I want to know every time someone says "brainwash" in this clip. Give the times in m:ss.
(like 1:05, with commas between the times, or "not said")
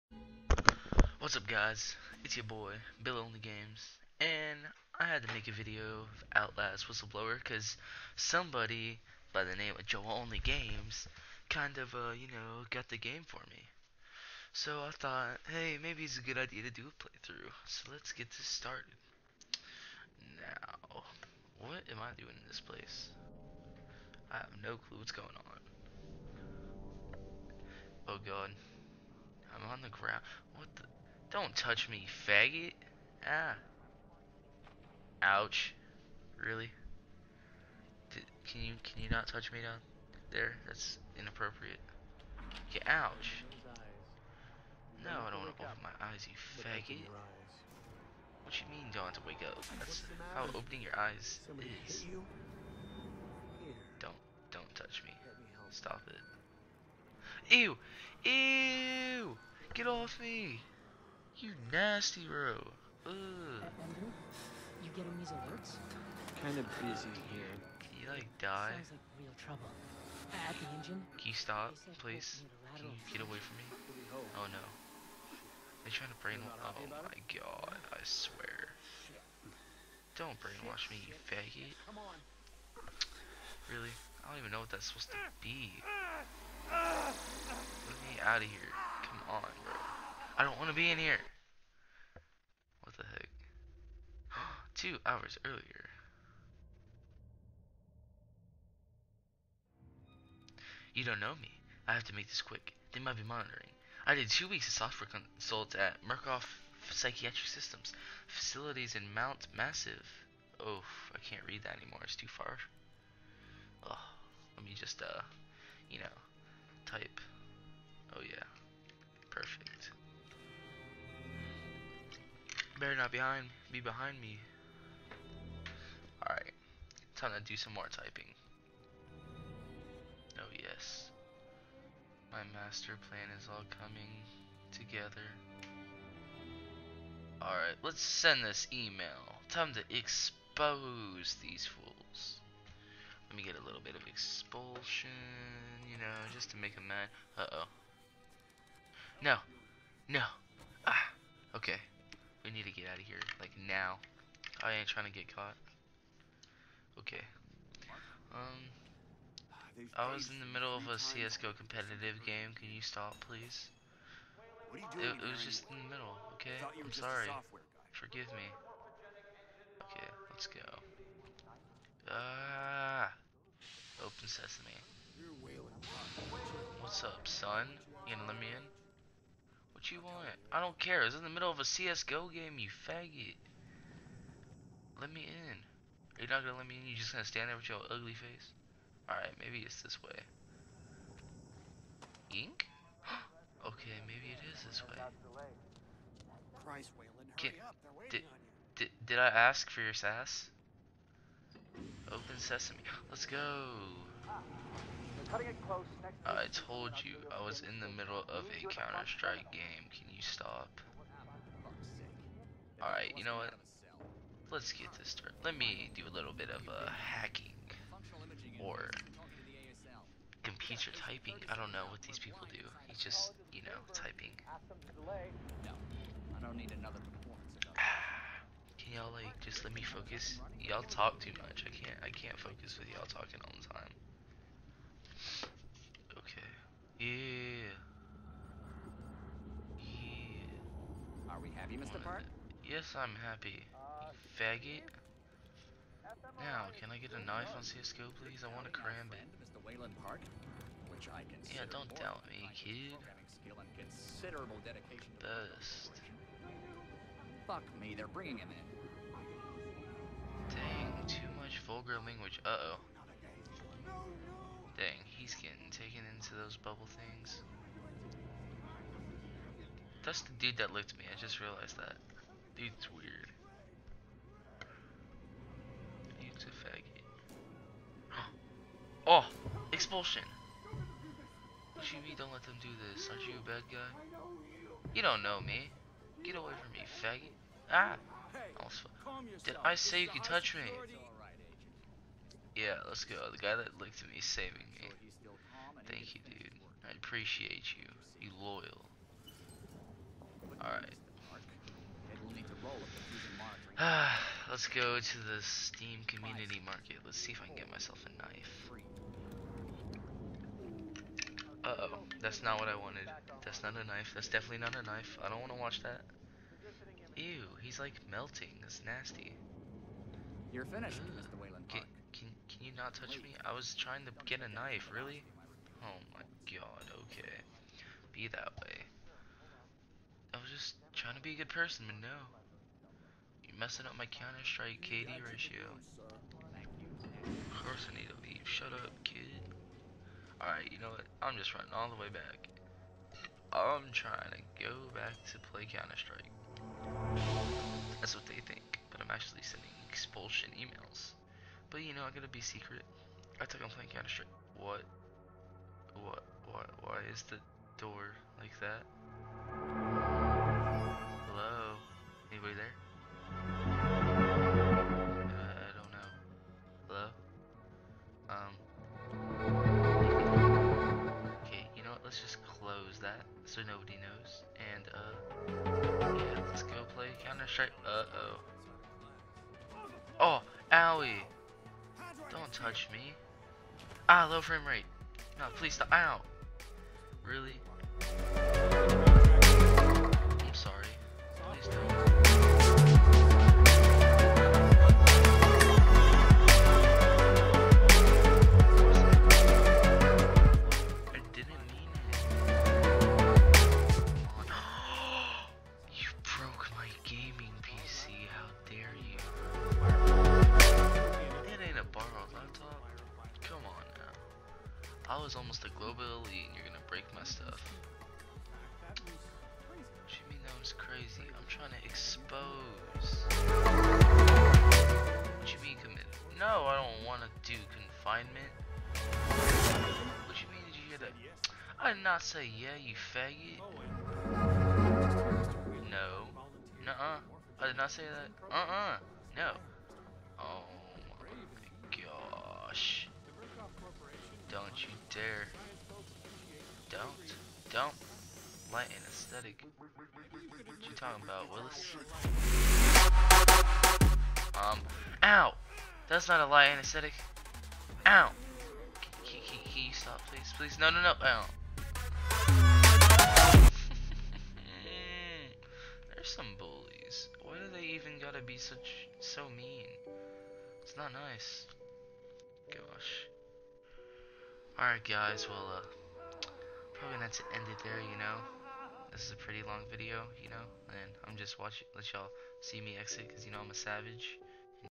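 1:16, 1:20.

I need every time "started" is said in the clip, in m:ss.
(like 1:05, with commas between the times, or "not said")
0:18, 3:35.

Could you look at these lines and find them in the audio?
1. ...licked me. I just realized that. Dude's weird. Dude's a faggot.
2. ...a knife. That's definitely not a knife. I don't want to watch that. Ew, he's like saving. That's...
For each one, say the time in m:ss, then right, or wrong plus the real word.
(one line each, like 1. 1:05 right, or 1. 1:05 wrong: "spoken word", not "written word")
1. 4:30 right
2. 5:13 wrong: "melting", not "saving".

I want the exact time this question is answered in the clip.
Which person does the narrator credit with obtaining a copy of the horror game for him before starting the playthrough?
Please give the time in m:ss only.
0:09.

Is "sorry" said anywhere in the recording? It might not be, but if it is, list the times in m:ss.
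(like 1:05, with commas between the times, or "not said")
2:46.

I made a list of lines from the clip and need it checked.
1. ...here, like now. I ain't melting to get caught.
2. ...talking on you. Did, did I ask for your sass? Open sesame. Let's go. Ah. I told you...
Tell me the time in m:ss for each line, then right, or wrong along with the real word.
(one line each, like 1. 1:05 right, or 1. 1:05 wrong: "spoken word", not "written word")
1. 2:33 wrong: "trying", not "melting"
2. 3:17 wrong: "waiting", not "talking".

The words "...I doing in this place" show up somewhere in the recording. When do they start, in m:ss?
0:22.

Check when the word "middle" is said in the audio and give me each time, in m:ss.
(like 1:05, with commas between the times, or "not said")
2:40, 2:45, 3:01, 3:27.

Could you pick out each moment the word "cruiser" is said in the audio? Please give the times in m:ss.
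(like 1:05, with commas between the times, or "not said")
not said.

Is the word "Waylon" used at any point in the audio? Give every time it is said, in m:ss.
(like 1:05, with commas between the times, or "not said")
3:16, 4:09, 5:21.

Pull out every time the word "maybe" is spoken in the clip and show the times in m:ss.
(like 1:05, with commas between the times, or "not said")
0:15, 3:09, 3:14.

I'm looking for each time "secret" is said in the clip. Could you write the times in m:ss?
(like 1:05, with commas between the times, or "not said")
5:52.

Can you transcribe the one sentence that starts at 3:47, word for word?
Ah, can y'all like just let me focus?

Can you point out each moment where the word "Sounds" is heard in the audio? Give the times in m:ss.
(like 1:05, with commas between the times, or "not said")
1:08.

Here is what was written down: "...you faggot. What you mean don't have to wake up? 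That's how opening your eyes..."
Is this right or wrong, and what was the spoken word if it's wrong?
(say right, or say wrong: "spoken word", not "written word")
right.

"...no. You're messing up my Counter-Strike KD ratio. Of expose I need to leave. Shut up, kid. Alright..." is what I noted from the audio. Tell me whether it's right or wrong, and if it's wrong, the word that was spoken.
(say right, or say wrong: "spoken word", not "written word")
wrong: "course", not "expose".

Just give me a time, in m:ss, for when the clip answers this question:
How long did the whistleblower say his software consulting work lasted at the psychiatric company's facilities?
1:44.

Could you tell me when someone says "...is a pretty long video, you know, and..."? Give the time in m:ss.
7:59.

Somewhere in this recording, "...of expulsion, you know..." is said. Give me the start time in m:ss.
2:23.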